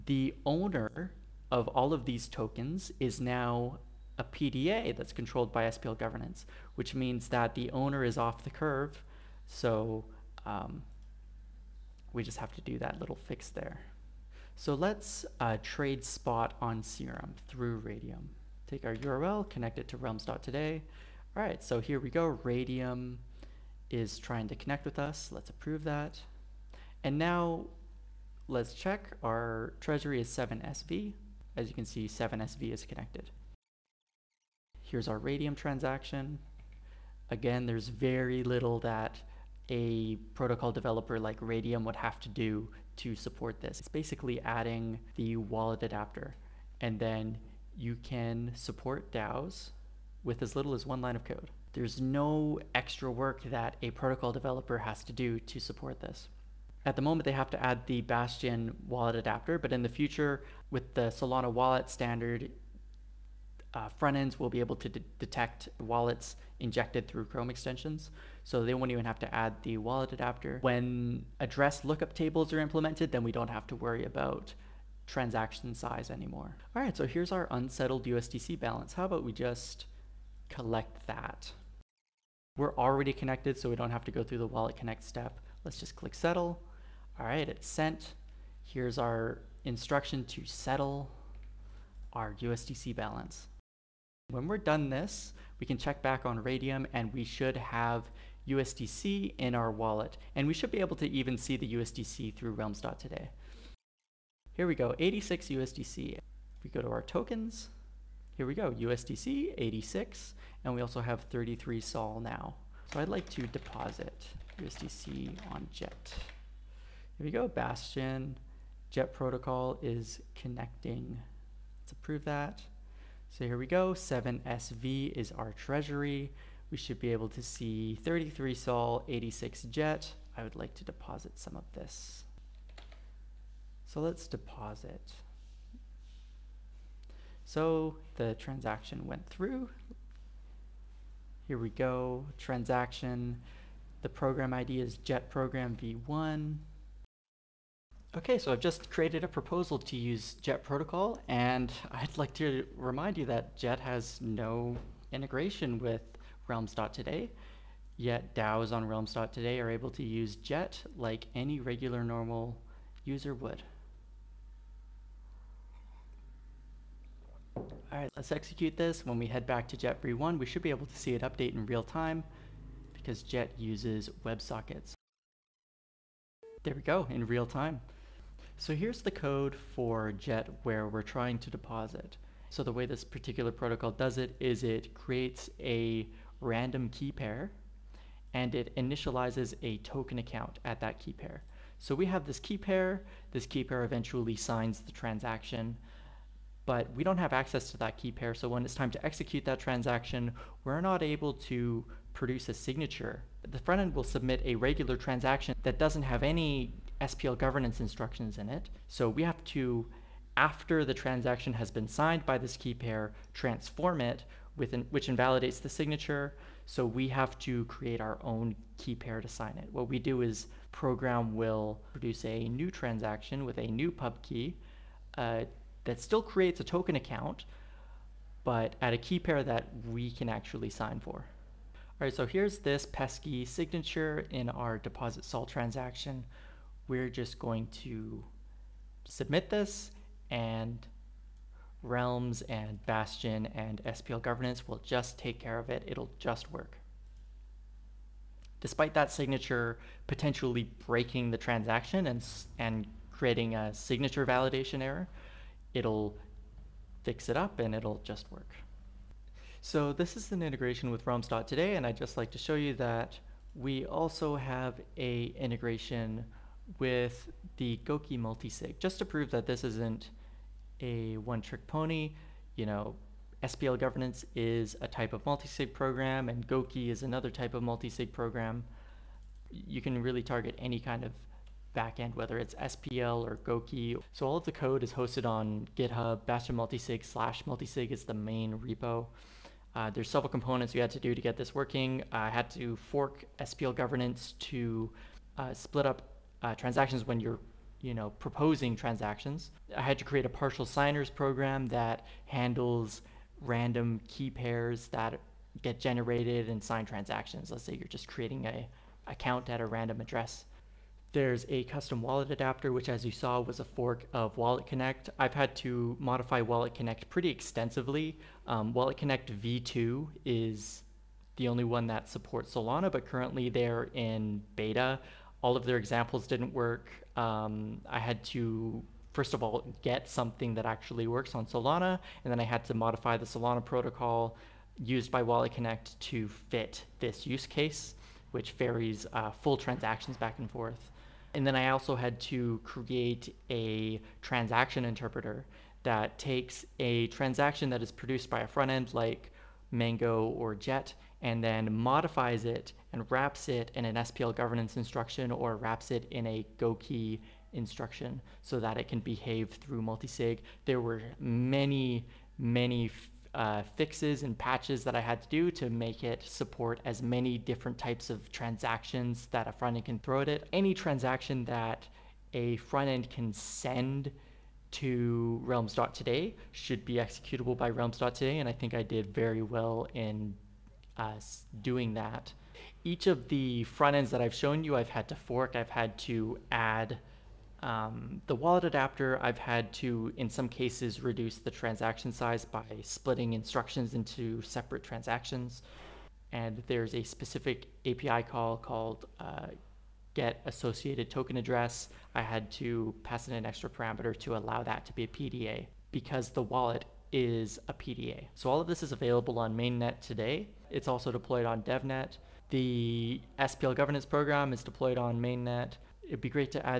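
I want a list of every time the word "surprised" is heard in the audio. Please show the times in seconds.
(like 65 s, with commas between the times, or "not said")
not said.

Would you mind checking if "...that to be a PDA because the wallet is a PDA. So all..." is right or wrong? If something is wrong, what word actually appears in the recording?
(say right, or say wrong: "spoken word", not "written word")
right.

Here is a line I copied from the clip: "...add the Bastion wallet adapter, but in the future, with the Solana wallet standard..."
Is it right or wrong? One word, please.
right.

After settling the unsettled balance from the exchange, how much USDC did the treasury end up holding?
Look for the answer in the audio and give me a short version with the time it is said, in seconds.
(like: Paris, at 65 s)
86, at 104 s.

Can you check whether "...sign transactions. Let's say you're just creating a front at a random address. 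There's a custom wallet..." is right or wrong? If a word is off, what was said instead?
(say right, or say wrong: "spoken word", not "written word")
wrong: "account", not "front".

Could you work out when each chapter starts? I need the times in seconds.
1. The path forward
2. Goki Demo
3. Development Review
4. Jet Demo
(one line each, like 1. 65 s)
1. 407 s
2. 259 s
3. 283 s
4. 111 s.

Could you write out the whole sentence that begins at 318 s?
Um, Wallet Connect v2 is the only one that supports Solana, but currently they're in beta all of their examples didn't work.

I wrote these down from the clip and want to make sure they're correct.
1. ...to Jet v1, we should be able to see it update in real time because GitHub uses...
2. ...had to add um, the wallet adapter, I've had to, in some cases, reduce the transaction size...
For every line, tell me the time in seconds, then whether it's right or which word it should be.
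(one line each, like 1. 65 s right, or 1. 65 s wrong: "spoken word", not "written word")
1. 169 s wrong: "JET", not "GitHub"
2. 385 s right.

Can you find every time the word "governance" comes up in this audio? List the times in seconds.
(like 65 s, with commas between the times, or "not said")
5 s, 207 s, 244 s, 273 s, 293 s, 354 s, 413 s.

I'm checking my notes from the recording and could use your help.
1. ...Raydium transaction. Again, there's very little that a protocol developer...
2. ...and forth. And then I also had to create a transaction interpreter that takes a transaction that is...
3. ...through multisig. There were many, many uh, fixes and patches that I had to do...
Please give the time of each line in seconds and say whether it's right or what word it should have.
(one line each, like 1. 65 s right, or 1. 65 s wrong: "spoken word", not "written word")
1. 35 s right
2. 340 s right
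3. 359 s right.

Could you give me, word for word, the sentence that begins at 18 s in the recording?
Take our URL, connect it to realms.today.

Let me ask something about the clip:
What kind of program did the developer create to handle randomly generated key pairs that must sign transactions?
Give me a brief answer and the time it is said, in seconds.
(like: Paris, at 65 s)
partial signers program, at 300 s.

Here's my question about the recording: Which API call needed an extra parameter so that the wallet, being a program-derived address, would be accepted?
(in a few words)
get associated token address.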